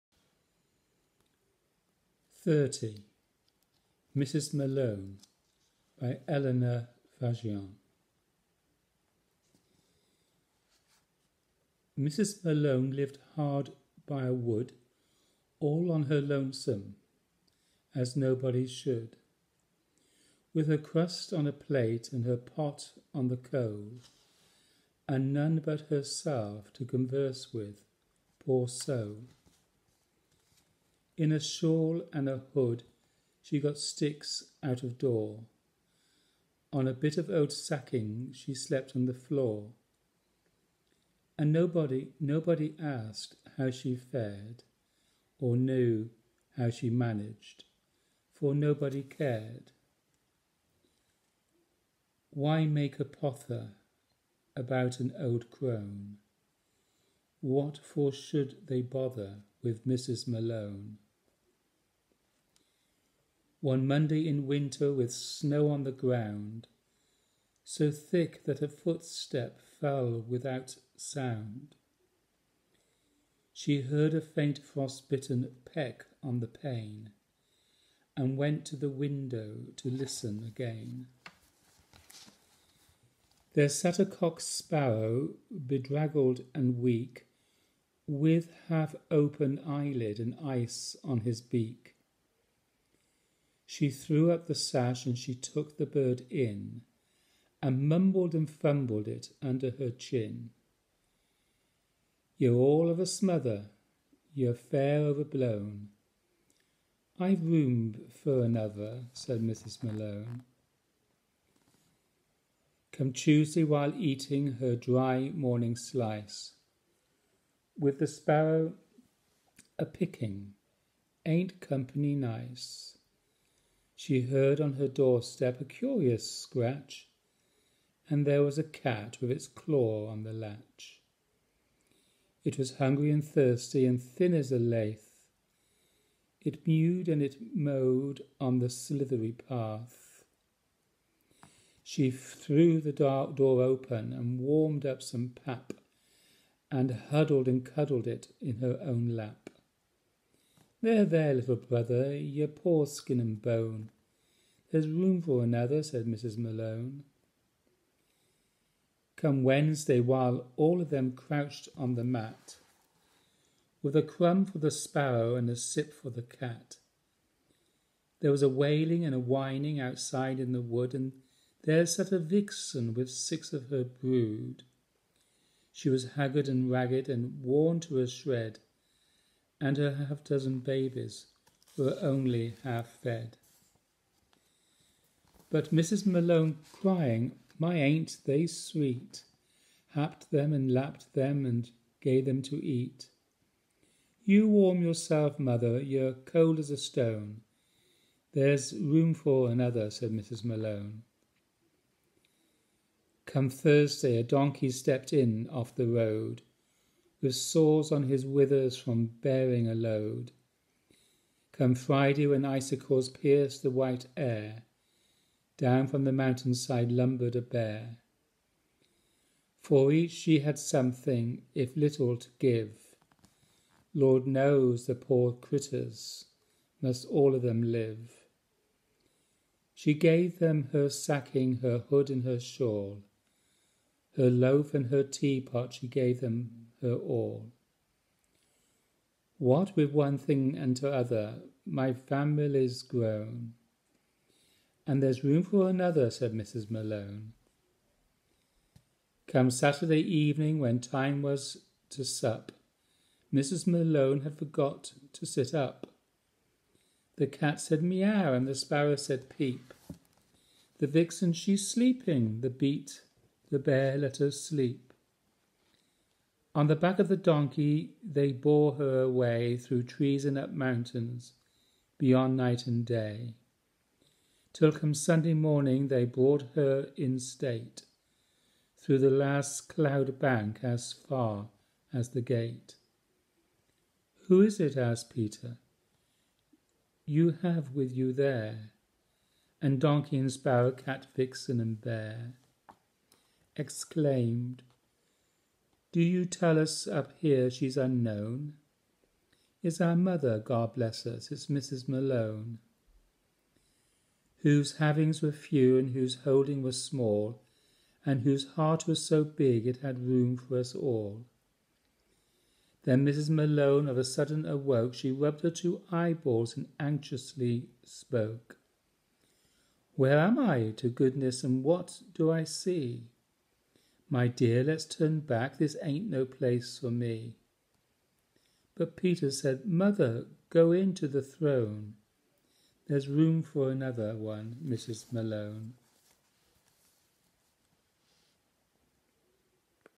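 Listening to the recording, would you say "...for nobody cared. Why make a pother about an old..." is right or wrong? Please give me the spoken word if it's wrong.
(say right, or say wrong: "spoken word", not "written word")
right.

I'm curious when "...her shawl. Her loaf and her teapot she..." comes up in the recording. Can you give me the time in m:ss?
3:52.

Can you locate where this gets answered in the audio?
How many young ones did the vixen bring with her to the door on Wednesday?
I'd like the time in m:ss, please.
2:53.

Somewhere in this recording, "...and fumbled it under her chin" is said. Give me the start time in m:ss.
1:38.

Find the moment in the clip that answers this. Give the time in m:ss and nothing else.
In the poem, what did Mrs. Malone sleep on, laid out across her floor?
0:37.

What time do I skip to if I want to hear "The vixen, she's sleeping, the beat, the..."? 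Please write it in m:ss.
4:20.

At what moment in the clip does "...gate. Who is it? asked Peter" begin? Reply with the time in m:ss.
4:42.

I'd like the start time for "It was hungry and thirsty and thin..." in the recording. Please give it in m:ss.
2:12.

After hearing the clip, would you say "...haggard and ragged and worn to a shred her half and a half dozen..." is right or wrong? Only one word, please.
right.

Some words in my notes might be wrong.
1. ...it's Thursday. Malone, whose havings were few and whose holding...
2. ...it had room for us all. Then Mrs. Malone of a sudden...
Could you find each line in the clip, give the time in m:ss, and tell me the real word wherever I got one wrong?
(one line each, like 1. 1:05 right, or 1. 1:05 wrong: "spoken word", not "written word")
1. 5:01 wrong: "Mrs", not "Thursday"
2. 5:09 right.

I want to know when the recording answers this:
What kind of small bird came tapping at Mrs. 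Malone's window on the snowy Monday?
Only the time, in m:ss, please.
1:24.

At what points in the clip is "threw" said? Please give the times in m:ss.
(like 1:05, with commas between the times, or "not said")
1:33, 2:22.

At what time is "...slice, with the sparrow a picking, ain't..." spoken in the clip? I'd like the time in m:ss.
1:55.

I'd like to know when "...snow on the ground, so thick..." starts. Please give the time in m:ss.
1:05.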